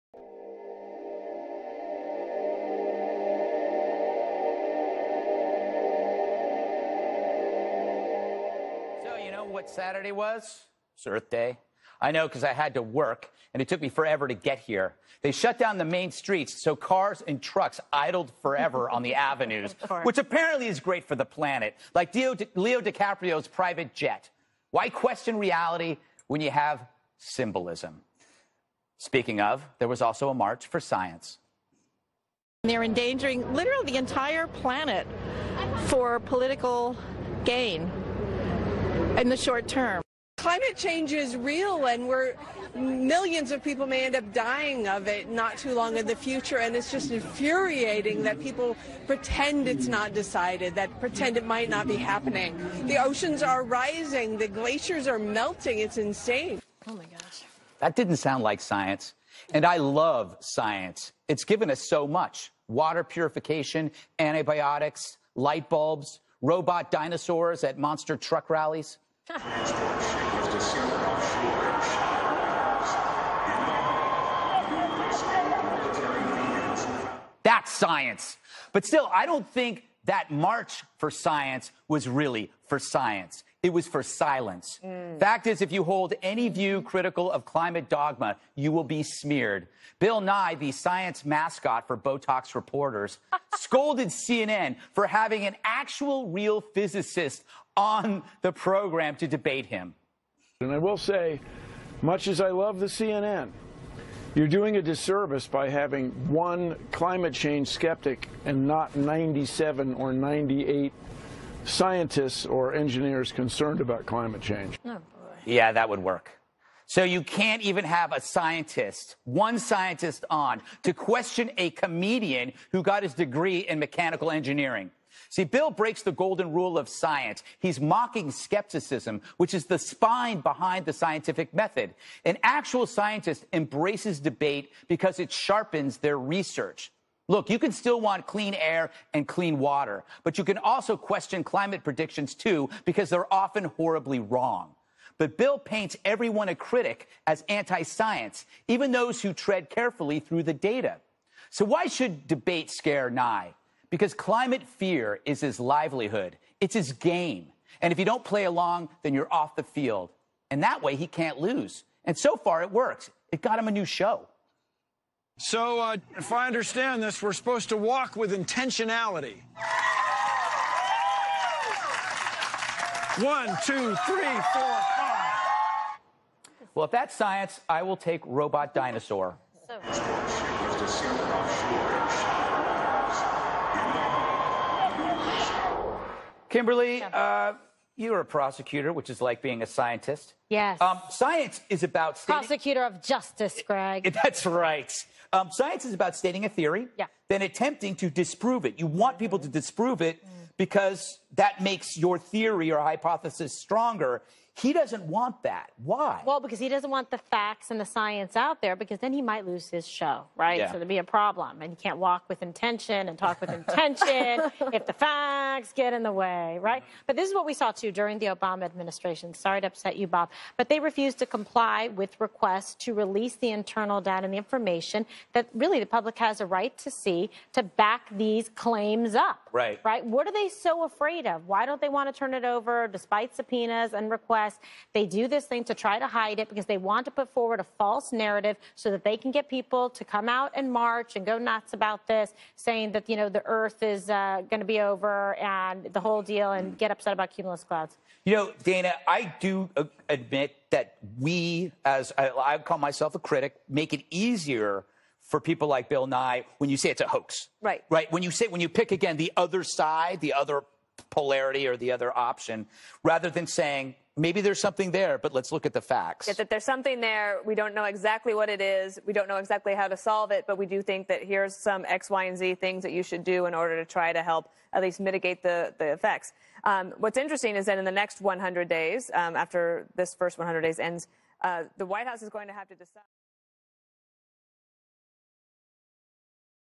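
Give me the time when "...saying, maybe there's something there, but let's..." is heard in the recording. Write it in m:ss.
4:23.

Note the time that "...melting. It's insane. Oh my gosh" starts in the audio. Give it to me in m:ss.
0:55.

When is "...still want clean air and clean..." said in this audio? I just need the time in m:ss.
2:17.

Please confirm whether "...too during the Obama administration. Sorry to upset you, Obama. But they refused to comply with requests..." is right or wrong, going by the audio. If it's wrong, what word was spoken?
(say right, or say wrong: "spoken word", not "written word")
wrong: "Bob", not "Obama".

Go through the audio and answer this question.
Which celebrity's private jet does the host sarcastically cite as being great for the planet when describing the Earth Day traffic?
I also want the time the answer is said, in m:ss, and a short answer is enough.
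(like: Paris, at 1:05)
Leo DiCaprio, at 0:22.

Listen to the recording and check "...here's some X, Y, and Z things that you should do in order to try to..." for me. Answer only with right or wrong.
right.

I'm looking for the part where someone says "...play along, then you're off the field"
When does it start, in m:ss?
2:38.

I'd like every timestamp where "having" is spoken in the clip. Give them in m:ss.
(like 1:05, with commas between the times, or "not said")
1:35, 1:45.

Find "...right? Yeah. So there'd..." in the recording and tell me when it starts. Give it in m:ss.
3:30.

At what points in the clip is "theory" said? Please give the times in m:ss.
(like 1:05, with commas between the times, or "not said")
3:16, 3:22.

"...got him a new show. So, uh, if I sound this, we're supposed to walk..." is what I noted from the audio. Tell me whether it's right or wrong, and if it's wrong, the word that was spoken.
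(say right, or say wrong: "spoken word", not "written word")
wrong: "understand", not "sound".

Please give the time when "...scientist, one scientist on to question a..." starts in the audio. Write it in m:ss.
1:58.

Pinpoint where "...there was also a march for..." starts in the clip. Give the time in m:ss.
0:29.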